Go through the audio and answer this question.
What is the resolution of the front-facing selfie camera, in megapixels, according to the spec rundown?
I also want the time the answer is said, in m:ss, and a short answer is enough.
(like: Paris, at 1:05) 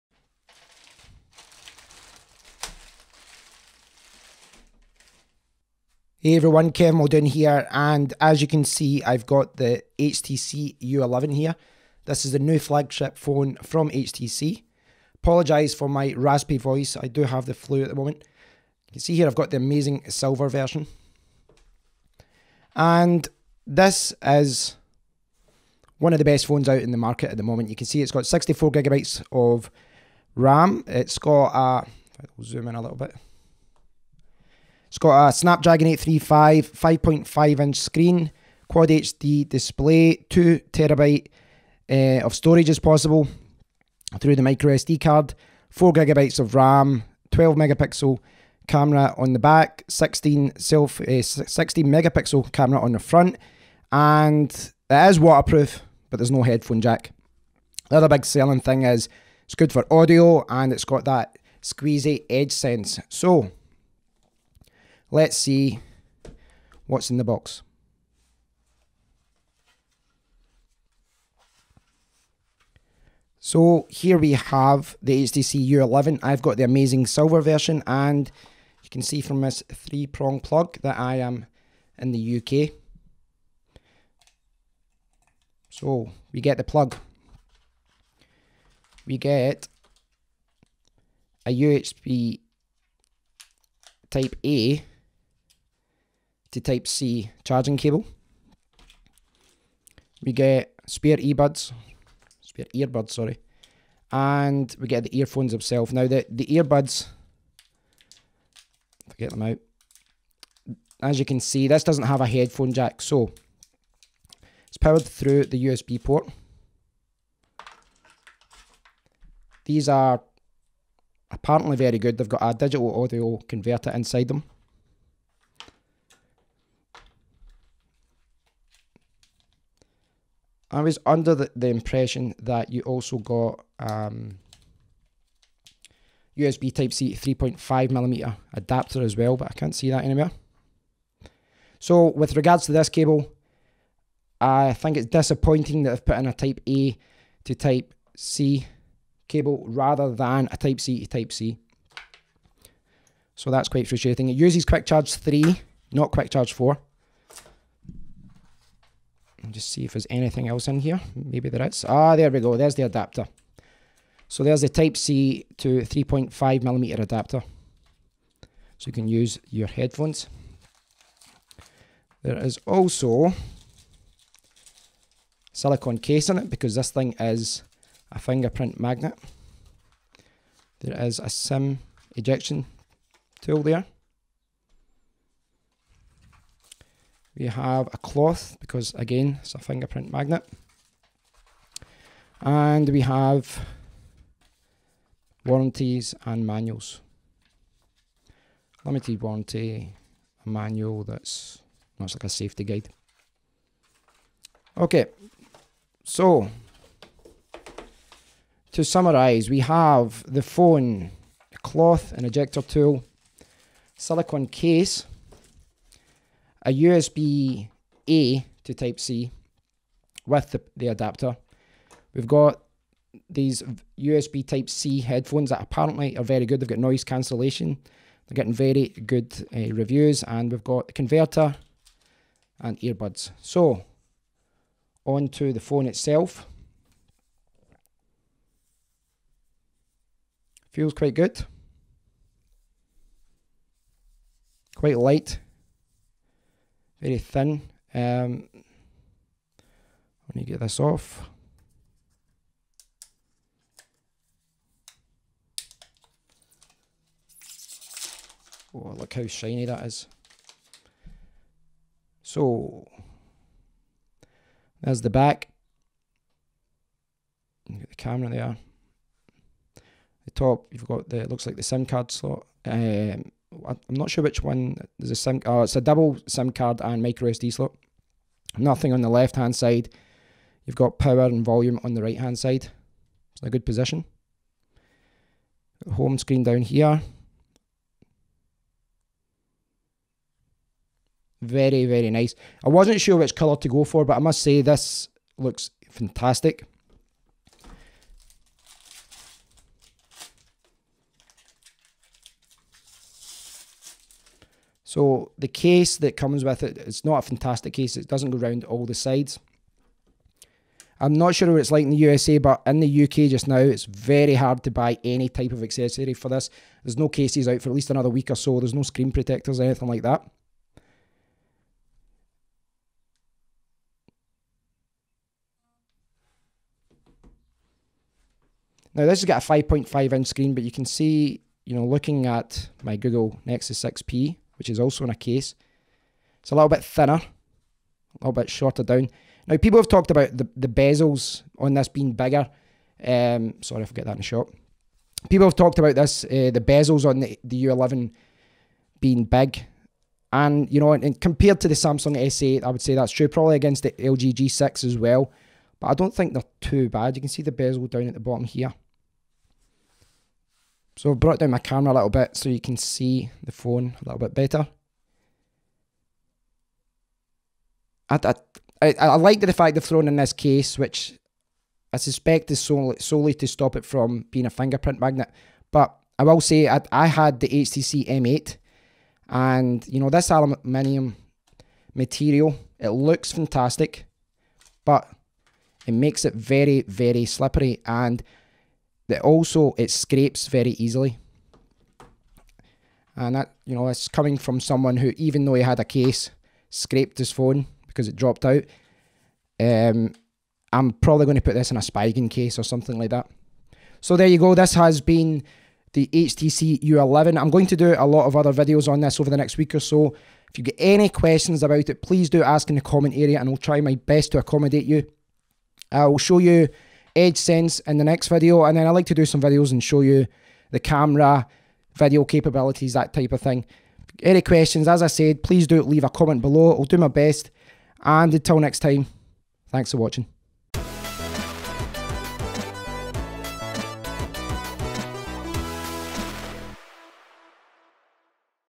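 16, at 0:51.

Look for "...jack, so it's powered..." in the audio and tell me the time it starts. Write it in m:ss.
1:52.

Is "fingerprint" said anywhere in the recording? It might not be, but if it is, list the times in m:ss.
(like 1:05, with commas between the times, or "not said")
2:58, 3:09, 6:14.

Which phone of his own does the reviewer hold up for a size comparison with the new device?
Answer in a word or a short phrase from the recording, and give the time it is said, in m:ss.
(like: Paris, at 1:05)
Google Nexus 6P, at 5:32.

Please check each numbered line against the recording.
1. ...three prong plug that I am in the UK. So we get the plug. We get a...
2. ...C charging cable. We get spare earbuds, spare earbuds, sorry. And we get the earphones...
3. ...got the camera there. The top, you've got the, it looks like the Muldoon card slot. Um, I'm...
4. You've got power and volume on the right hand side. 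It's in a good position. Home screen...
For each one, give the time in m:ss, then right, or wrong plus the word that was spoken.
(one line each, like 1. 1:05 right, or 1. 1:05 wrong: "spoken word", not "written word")
1. 1:19 right
2. 1:36 right
3. 4:27 wrong: "SIM", not "Muldoon"
4. 4:40 right.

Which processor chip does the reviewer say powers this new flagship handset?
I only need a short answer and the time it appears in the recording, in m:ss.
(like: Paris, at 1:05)
Snapdragon 835, at 0:35.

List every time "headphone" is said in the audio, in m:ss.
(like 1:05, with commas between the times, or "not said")
0:56, 1:52, 2:49, 3:45.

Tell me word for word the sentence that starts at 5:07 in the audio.
It doesn't go round all the sides.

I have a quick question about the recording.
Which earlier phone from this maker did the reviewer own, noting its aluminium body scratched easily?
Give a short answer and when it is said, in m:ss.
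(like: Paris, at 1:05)
HTC M8, at 6:17.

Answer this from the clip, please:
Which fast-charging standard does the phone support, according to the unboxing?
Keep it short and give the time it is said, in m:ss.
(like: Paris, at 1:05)
Quick Charge 3, at 2:34.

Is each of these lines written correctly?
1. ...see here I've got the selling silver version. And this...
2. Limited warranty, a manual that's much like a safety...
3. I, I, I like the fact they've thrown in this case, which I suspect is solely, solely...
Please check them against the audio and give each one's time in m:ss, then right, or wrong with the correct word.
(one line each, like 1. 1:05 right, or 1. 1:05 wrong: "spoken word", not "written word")
1. 0:19 wrong: "amazing", not "selling"
2. 3:18 right
3. 6:08 right.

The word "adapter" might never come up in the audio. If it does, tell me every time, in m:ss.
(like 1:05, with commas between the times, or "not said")
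2:18, 2:42, 2:47, 3:40.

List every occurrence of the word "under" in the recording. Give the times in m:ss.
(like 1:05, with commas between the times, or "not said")
2:11.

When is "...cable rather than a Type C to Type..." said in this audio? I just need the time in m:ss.
2:29.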